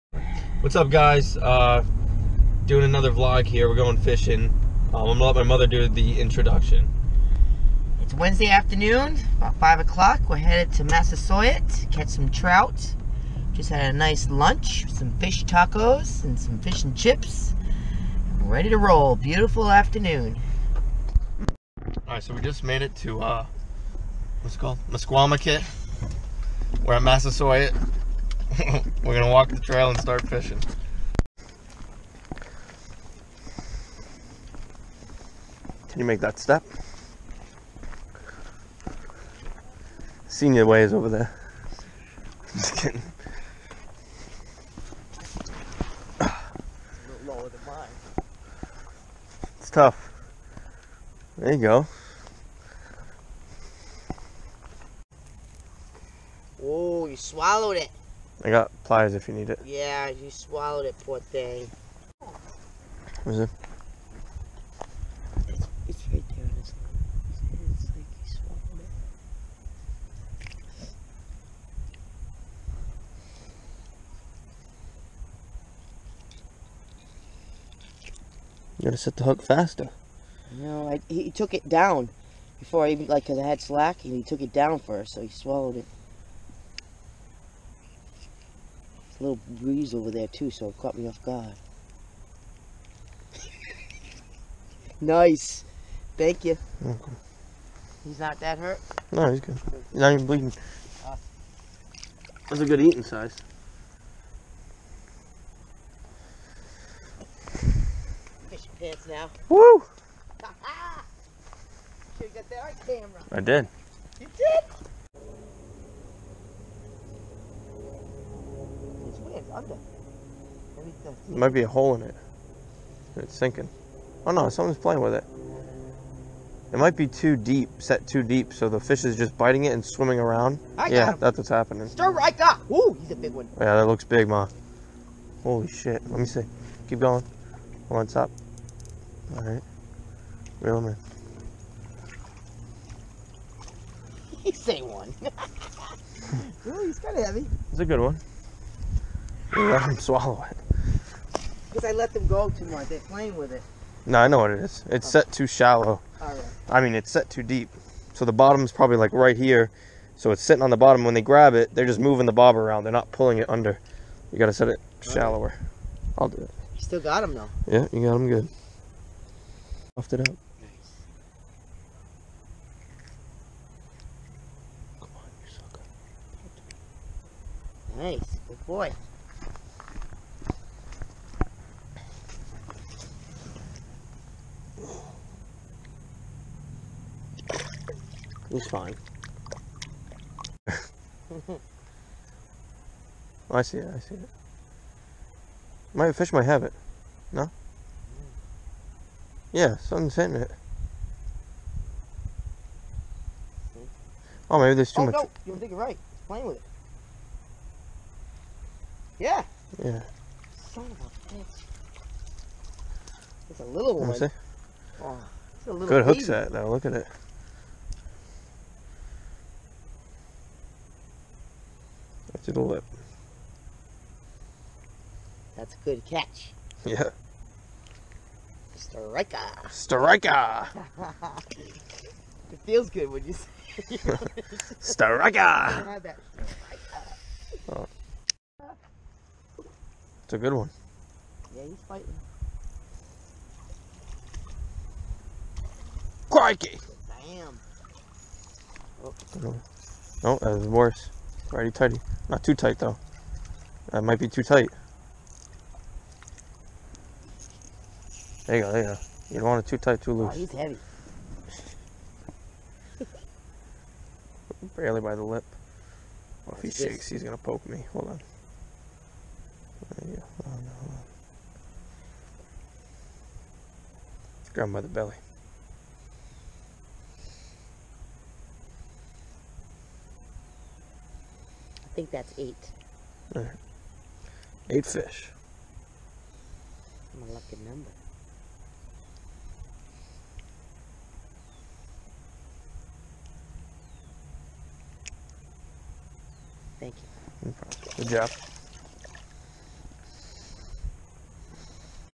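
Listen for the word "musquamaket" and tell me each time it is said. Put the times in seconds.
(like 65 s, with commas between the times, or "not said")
24 s.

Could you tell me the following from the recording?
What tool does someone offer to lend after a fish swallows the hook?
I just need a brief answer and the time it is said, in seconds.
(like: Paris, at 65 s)
Pliers, at 58 s.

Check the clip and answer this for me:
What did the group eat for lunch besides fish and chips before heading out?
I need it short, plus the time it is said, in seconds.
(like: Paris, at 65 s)
Fish tacos, at 15 s.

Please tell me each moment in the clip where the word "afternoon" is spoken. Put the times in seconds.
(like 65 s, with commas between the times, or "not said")
8 s, 19 s.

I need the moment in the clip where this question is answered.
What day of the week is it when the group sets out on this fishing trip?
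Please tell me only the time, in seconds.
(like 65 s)
8 s.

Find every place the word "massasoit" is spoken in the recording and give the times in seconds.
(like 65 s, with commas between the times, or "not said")
10 s, 27 s.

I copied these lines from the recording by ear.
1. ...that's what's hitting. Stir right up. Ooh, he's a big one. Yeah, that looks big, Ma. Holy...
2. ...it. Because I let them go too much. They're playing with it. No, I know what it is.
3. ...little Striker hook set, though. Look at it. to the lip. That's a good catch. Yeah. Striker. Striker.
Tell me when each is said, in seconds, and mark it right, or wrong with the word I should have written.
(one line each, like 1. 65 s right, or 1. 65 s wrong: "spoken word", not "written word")
1. 131 s wrong: "happening", not "hitting"
2. 150 s right
3. 215 s wrong: "Good", not "Striker".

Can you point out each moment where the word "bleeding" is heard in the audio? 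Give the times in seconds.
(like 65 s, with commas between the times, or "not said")
100 s.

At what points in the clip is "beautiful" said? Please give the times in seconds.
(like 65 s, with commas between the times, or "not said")
19 s.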